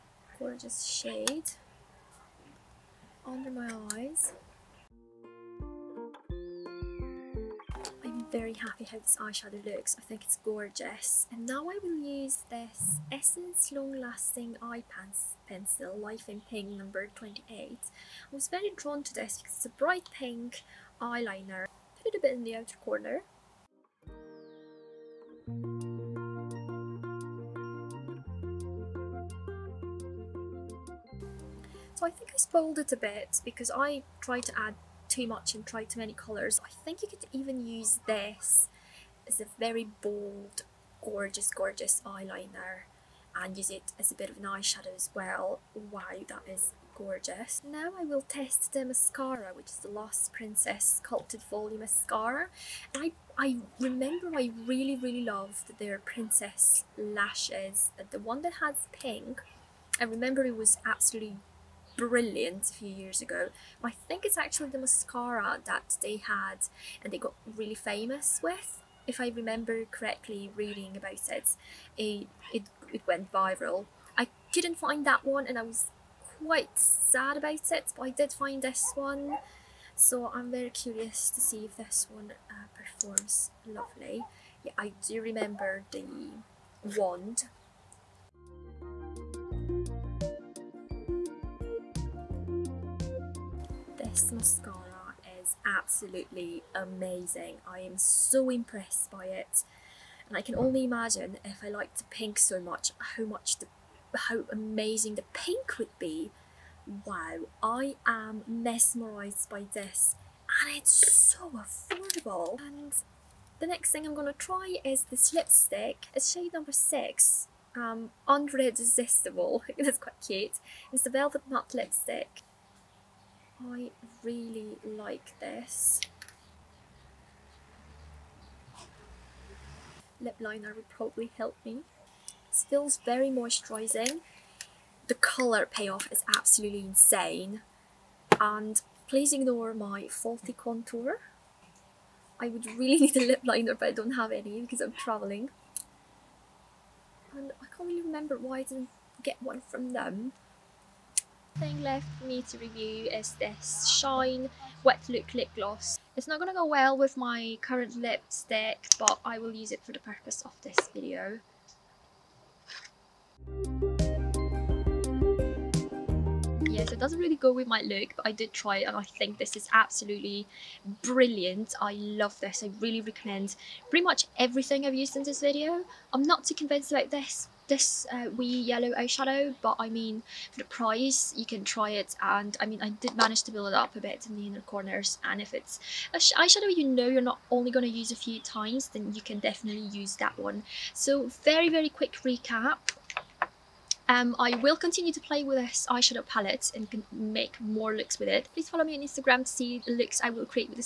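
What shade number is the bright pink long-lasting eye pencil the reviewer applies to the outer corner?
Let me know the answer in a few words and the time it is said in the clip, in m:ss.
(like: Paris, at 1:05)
28, at 0:16.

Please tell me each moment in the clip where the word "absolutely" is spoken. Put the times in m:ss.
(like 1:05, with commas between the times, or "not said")
1:00, 1:35, 2:16, 2:49.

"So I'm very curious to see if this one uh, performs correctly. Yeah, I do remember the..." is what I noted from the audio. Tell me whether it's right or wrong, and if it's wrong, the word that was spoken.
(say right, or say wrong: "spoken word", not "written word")
wrong: "lovely", not "correctly".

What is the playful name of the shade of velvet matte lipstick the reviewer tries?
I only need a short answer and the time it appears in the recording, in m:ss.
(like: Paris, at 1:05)
Unredsistible, at 1:58.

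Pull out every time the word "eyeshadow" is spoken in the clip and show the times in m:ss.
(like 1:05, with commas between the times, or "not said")
0:09, 0:44, 2:58, 3:06, 3:15.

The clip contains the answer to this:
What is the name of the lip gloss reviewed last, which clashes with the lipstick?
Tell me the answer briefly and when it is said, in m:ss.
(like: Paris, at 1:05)
Shine Wet Look Lip Gloss, at 2:33.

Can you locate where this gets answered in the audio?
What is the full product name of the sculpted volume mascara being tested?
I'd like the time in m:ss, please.
0:49.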